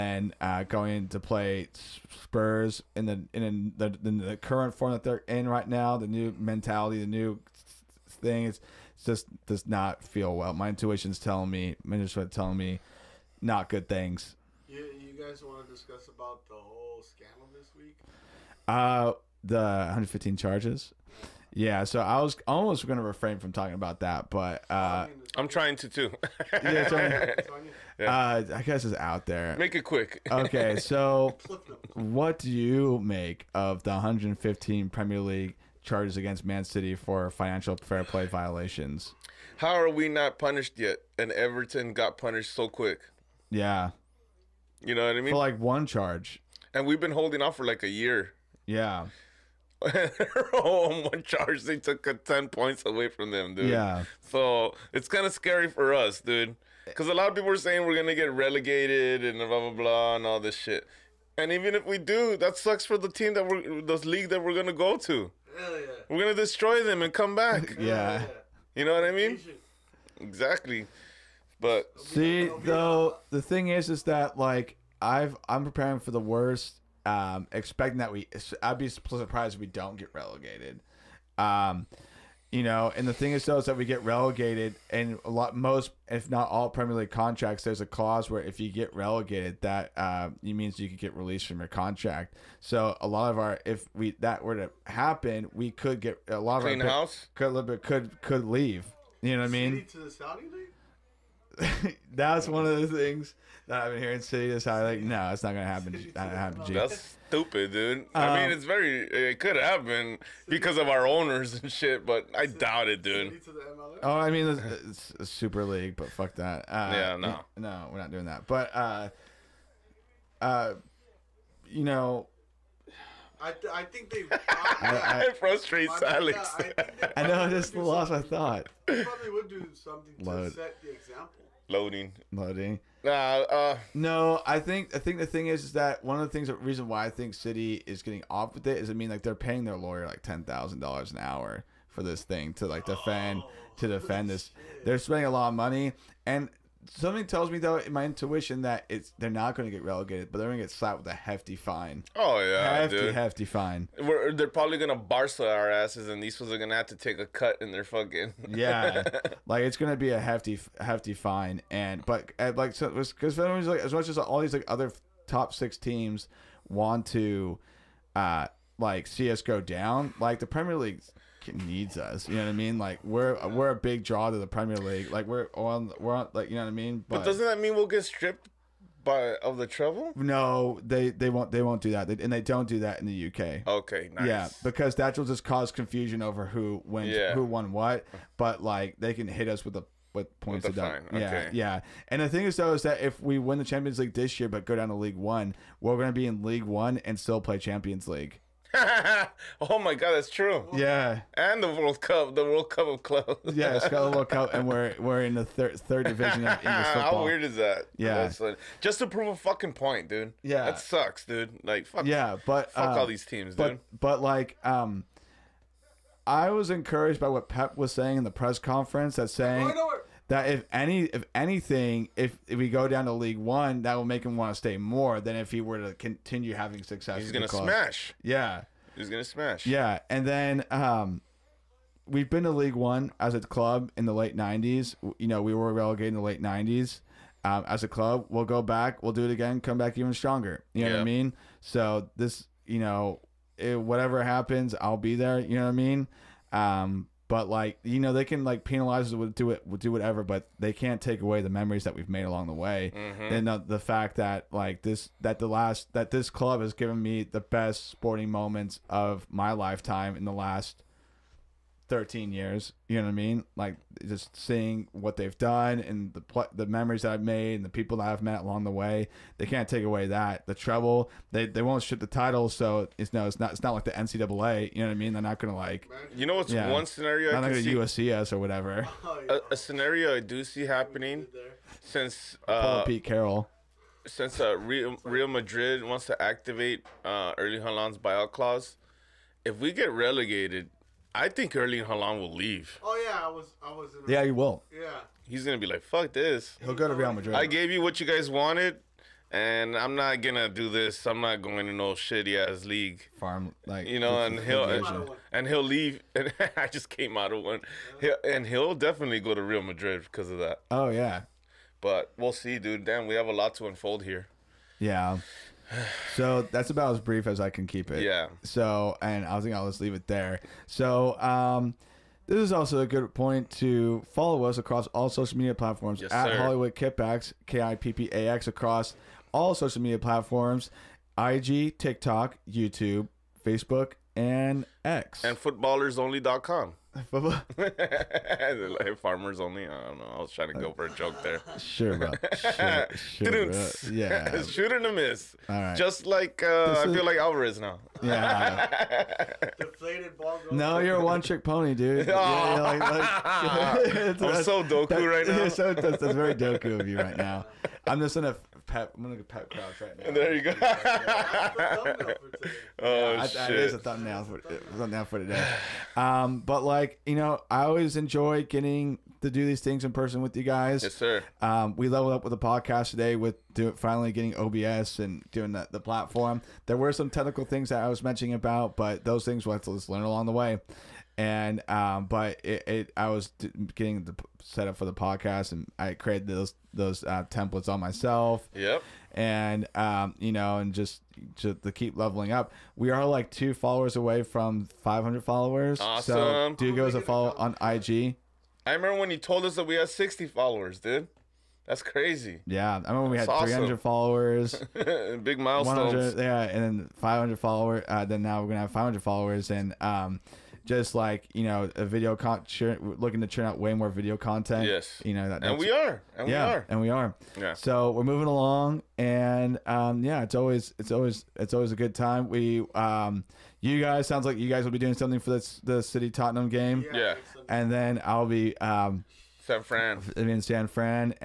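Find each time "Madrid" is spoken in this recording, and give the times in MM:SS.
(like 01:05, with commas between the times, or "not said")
04:45, 04:57, 05:09.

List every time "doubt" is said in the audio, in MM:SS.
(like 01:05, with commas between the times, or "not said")
01:52.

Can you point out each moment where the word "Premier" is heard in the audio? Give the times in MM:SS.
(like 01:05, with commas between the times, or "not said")
00:34, 01:26, 02:50, 02:54.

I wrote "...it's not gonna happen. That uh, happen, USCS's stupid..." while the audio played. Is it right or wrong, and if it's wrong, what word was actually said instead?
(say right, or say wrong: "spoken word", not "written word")
wrong: "That", not "USCS".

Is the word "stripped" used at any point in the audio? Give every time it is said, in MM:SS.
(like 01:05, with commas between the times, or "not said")
02:58.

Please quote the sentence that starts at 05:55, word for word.
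So, that's, that's, very Doku of you right now.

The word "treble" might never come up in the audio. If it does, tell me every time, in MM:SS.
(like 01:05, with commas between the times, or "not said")
02:59, 04:30.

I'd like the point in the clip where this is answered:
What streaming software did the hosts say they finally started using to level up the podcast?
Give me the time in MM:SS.
06:14.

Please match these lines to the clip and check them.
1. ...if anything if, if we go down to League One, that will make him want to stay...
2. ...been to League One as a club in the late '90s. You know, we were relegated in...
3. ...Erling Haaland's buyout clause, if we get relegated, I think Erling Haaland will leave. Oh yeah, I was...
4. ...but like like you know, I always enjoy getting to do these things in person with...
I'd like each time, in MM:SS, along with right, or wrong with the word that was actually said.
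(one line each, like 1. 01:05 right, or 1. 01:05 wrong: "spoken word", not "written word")
1. 03:41 right
2. 03:52 right
3. 04:47 right
4. 06:06 right.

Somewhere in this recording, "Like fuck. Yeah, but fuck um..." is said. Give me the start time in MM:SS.
03:31.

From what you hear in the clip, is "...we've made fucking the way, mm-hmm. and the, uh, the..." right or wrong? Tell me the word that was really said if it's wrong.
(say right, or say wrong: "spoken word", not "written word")
wrong: "along", not "fucking".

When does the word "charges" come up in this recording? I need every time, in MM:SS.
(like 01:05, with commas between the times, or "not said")
00:20, 00:35, 00:45, 00:51.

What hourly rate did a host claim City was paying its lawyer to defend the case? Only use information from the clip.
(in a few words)
$10,000.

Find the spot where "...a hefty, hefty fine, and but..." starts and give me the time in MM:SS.
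02:40.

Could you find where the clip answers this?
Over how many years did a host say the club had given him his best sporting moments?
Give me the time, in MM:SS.
04:21.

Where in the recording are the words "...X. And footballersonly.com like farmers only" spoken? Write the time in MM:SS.
05:34.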